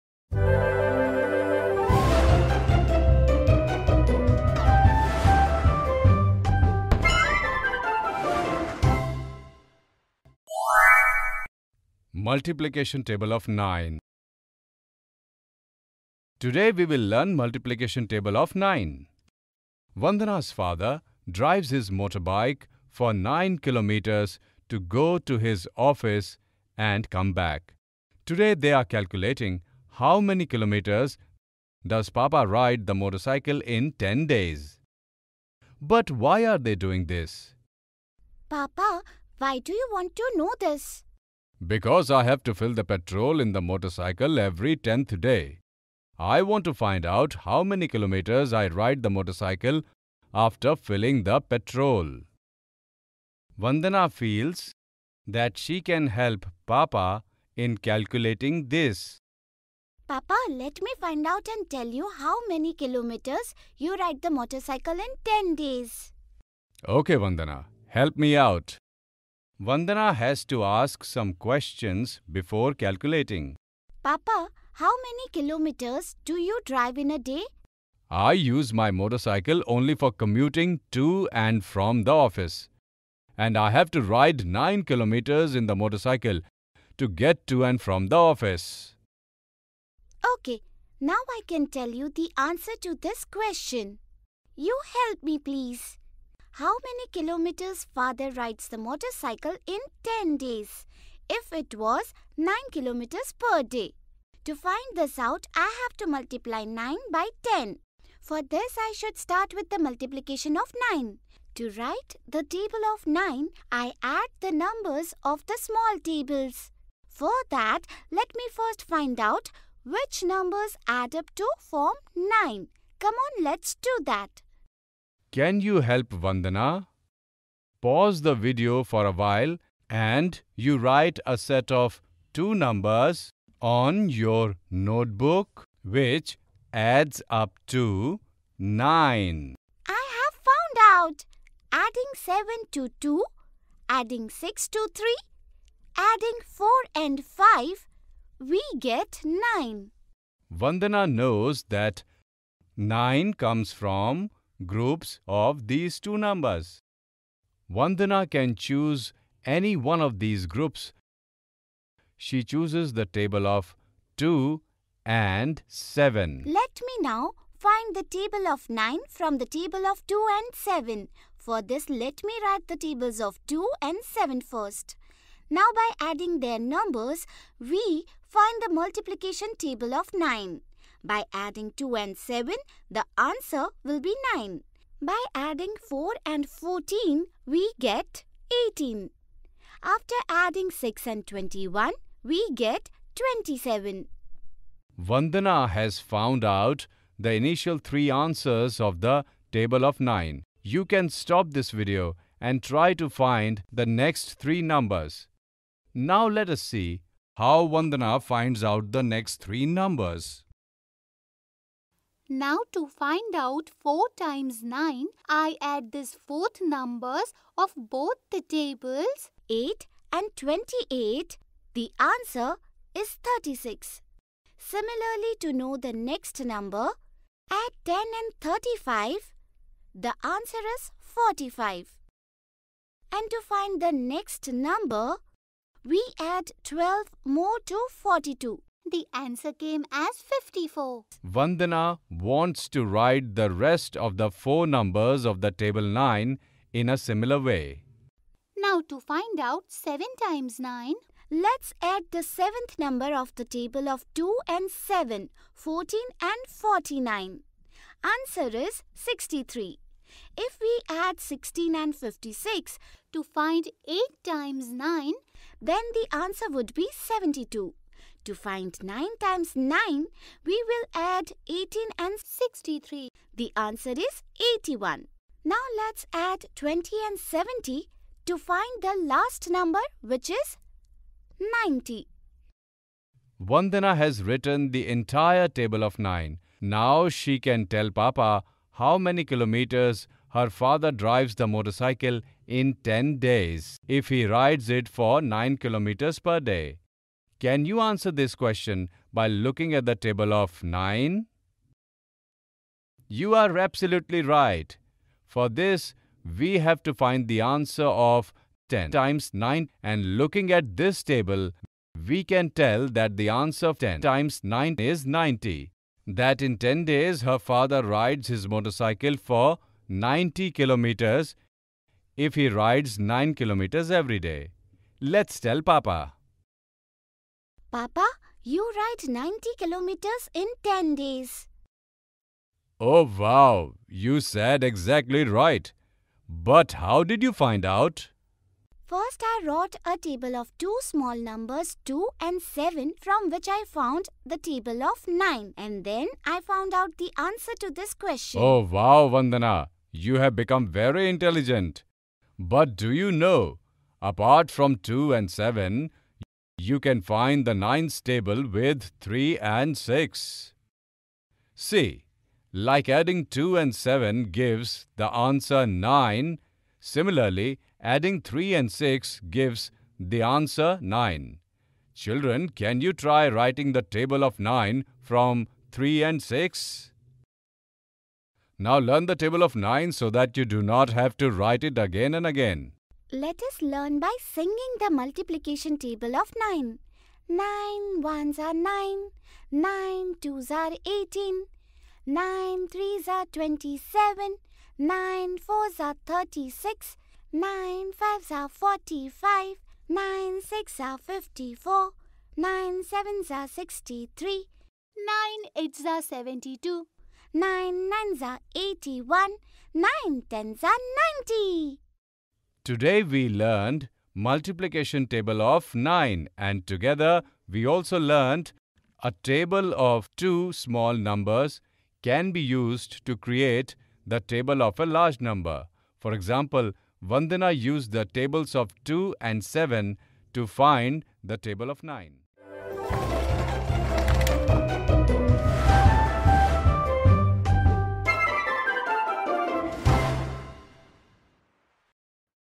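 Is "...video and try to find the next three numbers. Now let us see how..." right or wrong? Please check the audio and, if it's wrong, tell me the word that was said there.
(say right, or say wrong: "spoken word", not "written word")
right.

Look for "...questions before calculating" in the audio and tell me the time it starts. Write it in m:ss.
1:11.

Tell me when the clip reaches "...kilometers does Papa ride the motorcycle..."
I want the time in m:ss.
0:30.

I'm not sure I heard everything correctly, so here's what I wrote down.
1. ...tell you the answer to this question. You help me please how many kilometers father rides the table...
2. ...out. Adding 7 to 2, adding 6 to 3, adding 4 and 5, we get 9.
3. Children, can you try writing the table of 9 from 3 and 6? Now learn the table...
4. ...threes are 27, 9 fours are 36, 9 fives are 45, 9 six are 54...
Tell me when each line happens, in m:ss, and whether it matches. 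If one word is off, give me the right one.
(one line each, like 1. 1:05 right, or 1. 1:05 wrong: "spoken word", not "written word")
1. 1:31 wrong: "motorcycle", not "table"
2. 2:20 right
3. 6:11 right
4. 6:32 right.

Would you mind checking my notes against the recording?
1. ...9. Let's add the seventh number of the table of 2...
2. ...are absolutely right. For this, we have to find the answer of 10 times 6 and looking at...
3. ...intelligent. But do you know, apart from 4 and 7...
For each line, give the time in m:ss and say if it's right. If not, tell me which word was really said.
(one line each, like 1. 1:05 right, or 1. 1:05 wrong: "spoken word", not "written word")
1. 4:10 right
2. 5:03 wrong: "9", not "6"
3. 5:51 wrong: "2", not "4".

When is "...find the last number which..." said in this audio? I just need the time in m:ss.
4:38.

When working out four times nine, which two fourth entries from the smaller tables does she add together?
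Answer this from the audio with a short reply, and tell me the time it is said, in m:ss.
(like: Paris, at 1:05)
8 and 28, at 3:39.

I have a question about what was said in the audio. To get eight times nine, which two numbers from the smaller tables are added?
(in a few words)
16 and 56.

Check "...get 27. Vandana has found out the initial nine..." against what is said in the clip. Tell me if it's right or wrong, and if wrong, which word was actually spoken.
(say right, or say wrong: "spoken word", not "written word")
wrong: "three", not "nine".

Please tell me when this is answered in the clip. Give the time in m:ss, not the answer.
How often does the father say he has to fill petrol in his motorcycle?
0:44.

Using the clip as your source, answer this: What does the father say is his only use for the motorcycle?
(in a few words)
commuting to and from the office.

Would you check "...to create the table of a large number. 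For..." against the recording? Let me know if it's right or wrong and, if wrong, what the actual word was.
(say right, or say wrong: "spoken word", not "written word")
right.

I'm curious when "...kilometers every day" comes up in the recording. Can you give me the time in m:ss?
5:23.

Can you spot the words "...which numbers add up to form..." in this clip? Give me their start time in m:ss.
1:59.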